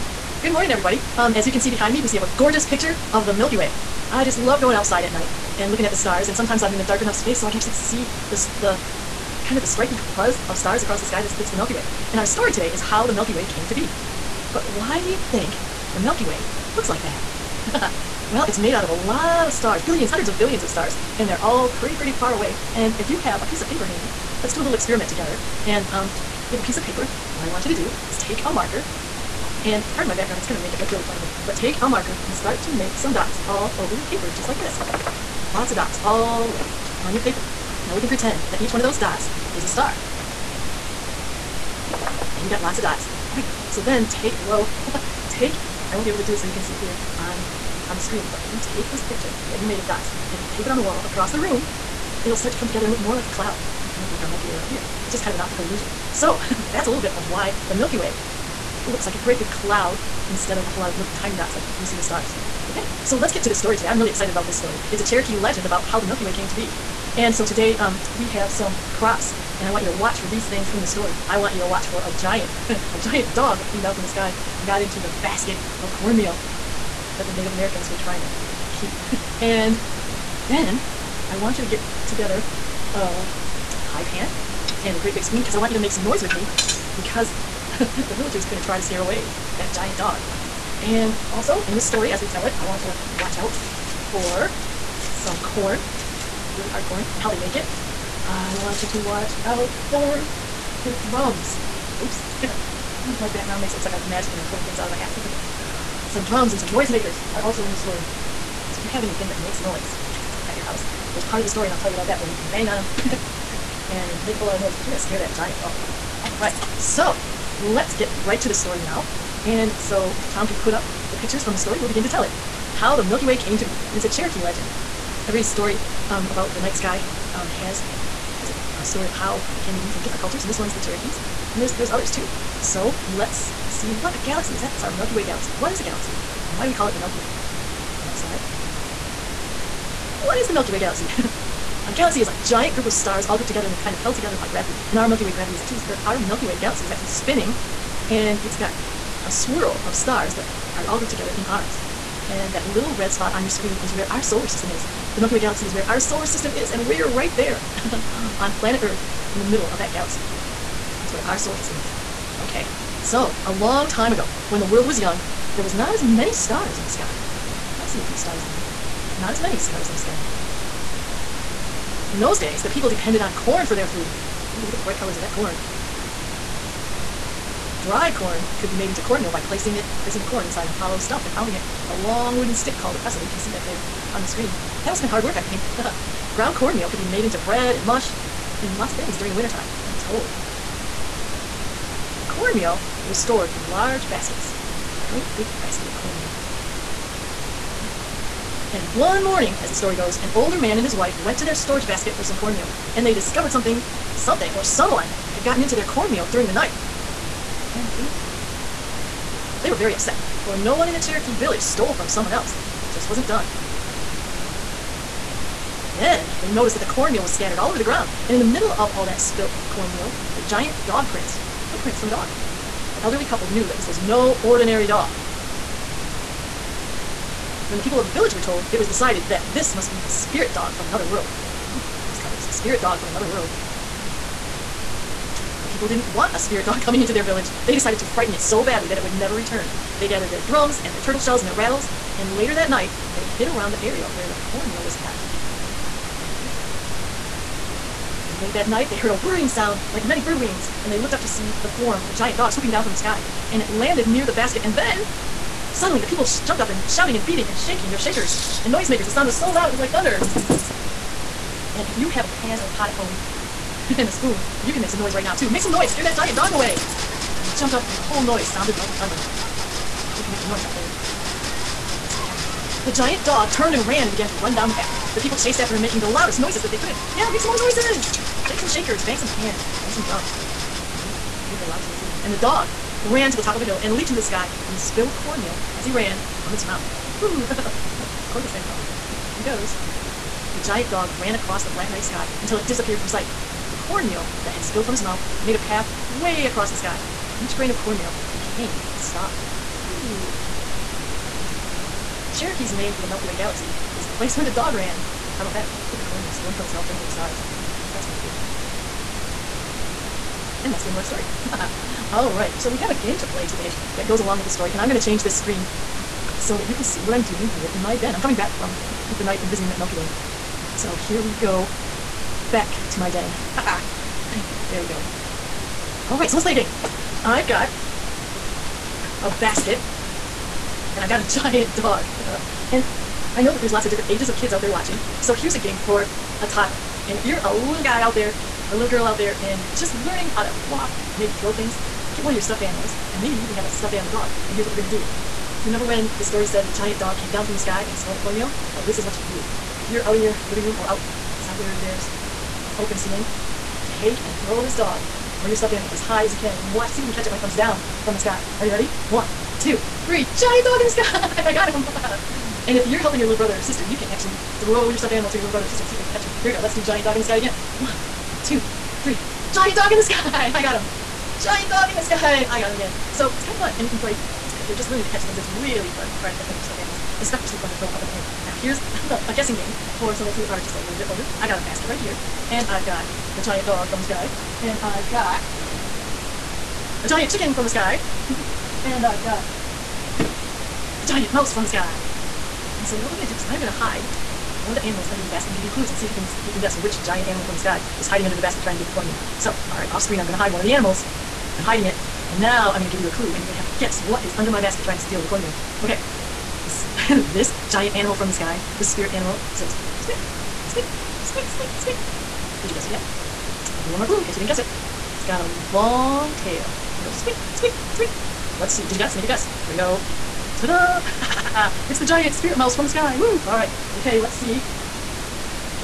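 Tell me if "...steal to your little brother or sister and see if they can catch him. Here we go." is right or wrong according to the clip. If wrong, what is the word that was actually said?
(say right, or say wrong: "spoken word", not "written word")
wrong: "animal", not "steal".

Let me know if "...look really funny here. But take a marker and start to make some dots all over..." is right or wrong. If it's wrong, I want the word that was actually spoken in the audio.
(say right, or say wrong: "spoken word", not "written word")
right.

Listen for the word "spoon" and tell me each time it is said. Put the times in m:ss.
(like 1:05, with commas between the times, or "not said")
1:25, 4:24.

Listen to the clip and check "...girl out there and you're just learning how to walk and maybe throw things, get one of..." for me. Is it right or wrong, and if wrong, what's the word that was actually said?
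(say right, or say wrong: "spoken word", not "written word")
right.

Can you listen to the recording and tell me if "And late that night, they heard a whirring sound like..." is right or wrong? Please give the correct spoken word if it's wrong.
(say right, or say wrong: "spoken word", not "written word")
right.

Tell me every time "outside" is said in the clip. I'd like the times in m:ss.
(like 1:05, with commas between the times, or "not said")
0:04, 5:50.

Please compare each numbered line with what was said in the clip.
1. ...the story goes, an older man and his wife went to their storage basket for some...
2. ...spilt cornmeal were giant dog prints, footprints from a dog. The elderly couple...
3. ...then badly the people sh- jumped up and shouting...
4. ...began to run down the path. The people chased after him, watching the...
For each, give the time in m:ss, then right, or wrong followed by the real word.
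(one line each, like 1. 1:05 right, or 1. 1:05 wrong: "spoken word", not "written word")
1. 3:19 right
2. 3:39 right
3. 4:14 wrong: "suddenly", not "badly"
4. 4:34 wrong: "making", not "watching".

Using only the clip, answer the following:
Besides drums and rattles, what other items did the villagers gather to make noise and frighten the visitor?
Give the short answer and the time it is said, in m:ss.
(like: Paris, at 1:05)
Turtle shells, at 4:01.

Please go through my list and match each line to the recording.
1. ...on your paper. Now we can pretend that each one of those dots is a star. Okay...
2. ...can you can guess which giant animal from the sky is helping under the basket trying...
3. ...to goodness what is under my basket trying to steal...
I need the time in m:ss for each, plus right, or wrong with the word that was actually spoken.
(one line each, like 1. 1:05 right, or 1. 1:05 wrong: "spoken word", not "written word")
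1. 0:37 right
2. 6:36 wrong: "hiding", not "helping"
3. 6:43 wrong: "guess", not "goodness".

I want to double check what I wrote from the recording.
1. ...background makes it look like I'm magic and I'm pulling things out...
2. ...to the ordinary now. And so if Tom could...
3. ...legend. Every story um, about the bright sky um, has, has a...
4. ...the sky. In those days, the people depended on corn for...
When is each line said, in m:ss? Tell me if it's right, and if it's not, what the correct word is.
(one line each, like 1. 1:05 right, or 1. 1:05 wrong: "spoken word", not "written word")
1. 1:43 right
2. 1:58 wrong: "story", not "ordinary"
3. 2:04 wrong: "night", not "bright"
4. 2:49 right.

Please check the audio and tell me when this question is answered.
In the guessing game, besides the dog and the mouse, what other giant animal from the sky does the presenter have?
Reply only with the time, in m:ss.
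6:27.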